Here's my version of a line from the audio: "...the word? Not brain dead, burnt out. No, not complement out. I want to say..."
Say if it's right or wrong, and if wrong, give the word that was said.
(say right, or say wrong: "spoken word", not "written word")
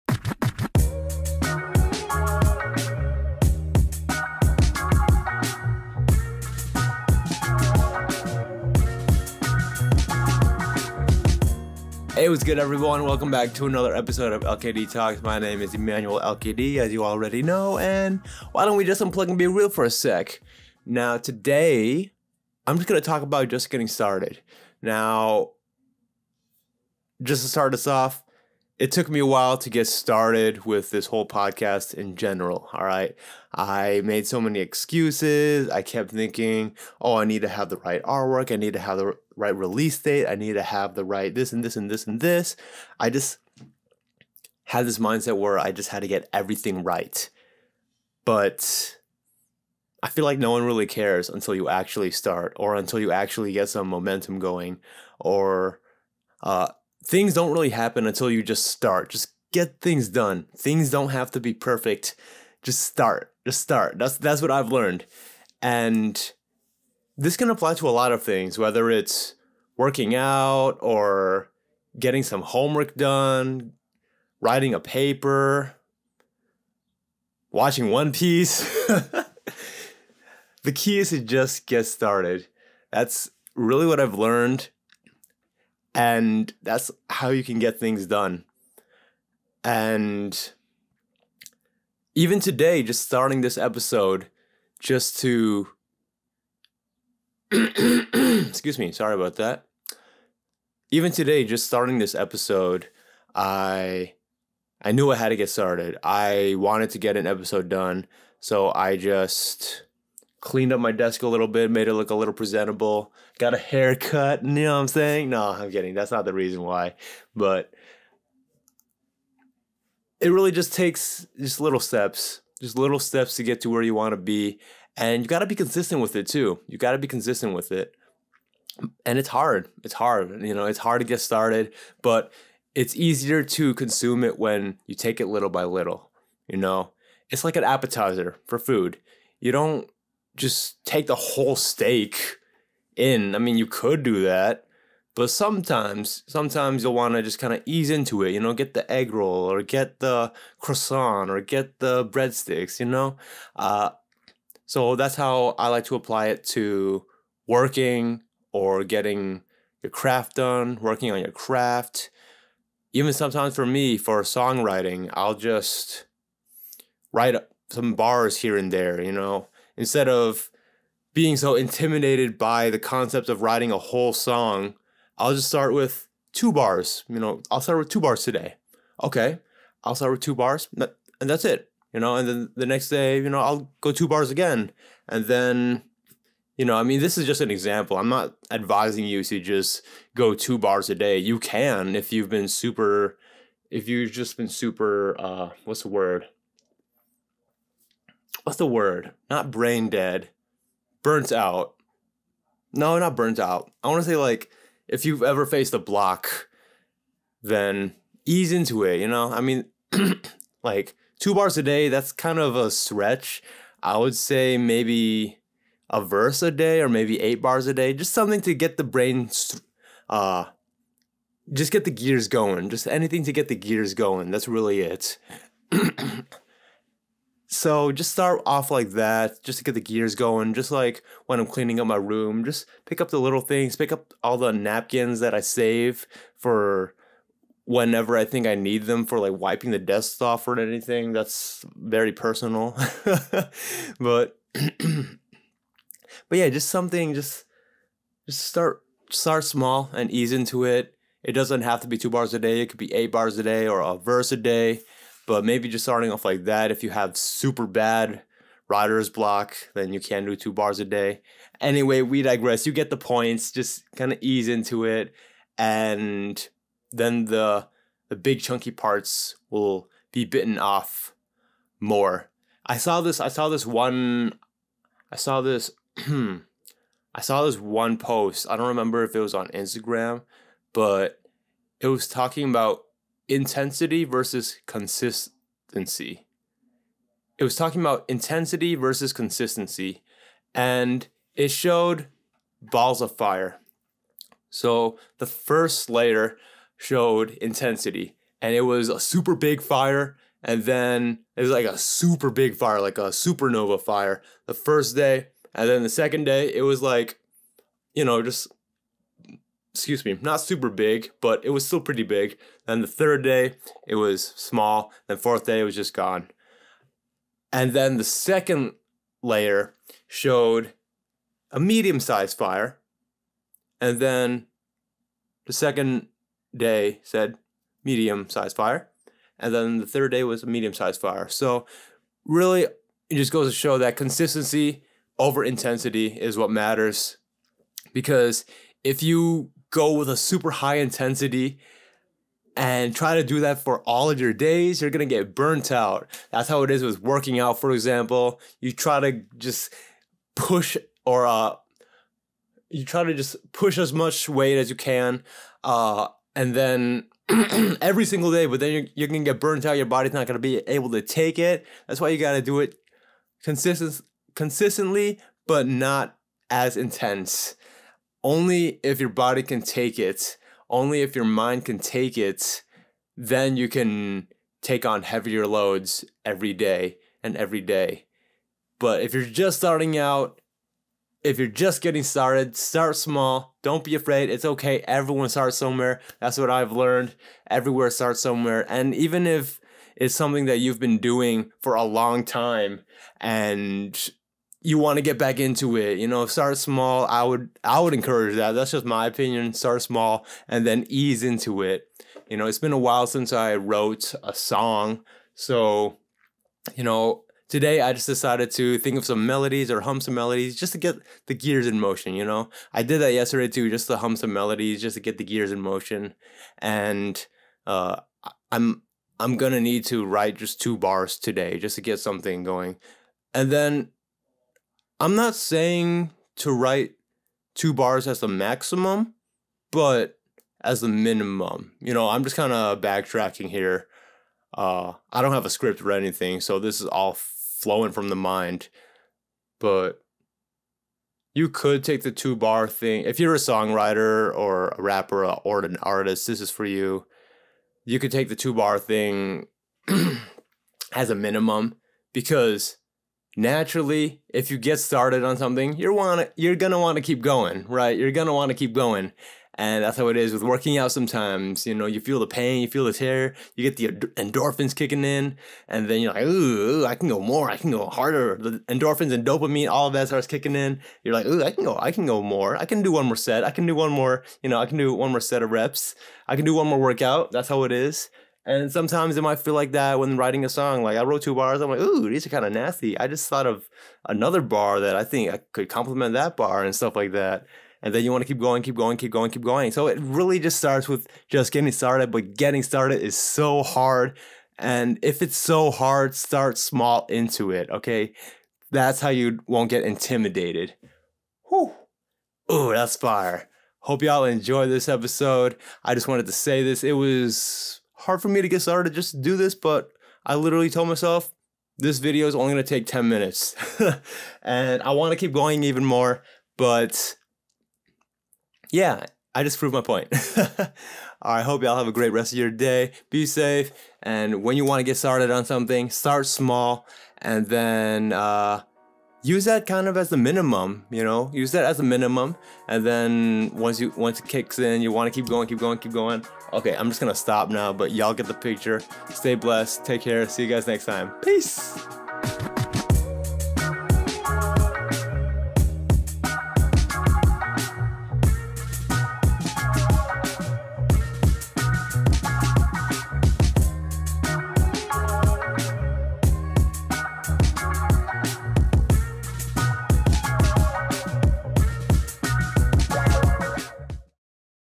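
wrong: "burnt", not "complement".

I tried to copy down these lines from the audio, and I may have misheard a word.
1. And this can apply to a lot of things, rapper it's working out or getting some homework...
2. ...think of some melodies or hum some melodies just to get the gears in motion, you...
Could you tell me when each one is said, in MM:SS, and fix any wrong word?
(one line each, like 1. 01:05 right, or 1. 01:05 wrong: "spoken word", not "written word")
1. 01:05 wrong: "whether", not "rapper"
2. 06:48 right.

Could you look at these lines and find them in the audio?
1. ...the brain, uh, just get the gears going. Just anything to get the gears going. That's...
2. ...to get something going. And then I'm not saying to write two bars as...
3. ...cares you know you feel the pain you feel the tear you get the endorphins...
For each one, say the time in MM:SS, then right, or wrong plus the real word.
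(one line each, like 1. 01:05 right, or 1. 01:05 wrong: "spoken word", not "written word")
1. 03:38 right
2. 07:01 right
3. 07:40 wrong: "sometimes", not "cares".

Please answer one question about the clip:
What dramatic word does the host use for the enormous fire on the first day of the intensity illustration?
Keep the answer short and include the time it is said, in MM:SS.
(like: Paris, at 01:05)
Supernova, at 05:03.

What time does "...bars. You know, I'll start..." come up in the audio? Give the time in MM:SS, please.
02:56.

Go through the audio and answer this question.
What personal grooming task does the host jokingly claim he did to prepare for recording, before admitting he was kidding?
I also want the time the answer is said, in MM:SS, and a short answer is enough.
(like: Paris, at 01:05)
A haircut, at 01:53.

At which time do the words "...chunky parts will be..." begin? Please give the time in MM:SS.
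04:28.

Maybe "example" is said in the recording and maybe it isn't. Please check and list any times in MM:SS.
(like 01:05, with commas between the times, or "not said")
03:07, 05:47.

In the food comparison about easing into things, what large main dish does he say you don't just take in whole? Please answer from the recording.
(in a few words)
Steak.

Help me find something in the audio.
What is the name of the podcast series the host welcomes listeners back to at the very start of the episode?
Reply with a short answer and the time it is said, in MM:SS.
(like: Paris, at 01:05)
LKD Talks, at 00:14.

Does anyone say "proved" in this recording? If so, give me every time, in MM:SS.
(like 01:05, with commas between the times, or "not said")
08:39.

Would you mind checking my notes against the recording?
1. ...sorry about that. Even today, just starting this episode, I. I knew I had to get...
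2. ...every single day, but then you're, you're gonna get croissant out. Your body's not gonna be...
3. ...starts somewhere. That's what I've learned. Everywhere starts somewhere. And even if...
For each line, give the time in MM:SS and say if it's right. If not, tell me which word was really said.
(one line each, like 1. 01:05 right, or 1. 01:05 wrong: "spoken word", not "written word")
1. 01:38 right
2. 05:57 wrong: "burnt", not "croissant"
3. 06:25 right.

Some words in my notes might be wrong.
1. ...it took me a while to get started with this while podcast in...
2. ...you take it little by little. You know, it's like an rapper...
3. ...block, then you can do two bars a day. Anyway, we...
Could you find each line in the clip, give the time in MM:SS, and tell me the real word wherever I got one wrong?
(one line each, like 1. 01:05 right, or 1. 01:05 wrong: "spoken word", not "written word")
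1. 00:28 wrong: "whole", not "while"
2. 02:14 wrong: "appetizer", not "rapper"
3. 04:19 right.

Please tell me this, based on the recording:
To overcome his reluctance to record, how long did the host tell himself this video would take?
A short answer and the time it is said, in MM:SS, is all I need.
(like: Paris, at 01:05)
10 minutes, at 08:32.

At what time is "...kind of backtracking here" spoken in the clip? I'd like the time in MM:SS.
07:12.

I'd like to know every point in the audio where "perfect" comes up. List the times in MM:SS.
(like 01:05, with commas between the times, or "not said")
01:01.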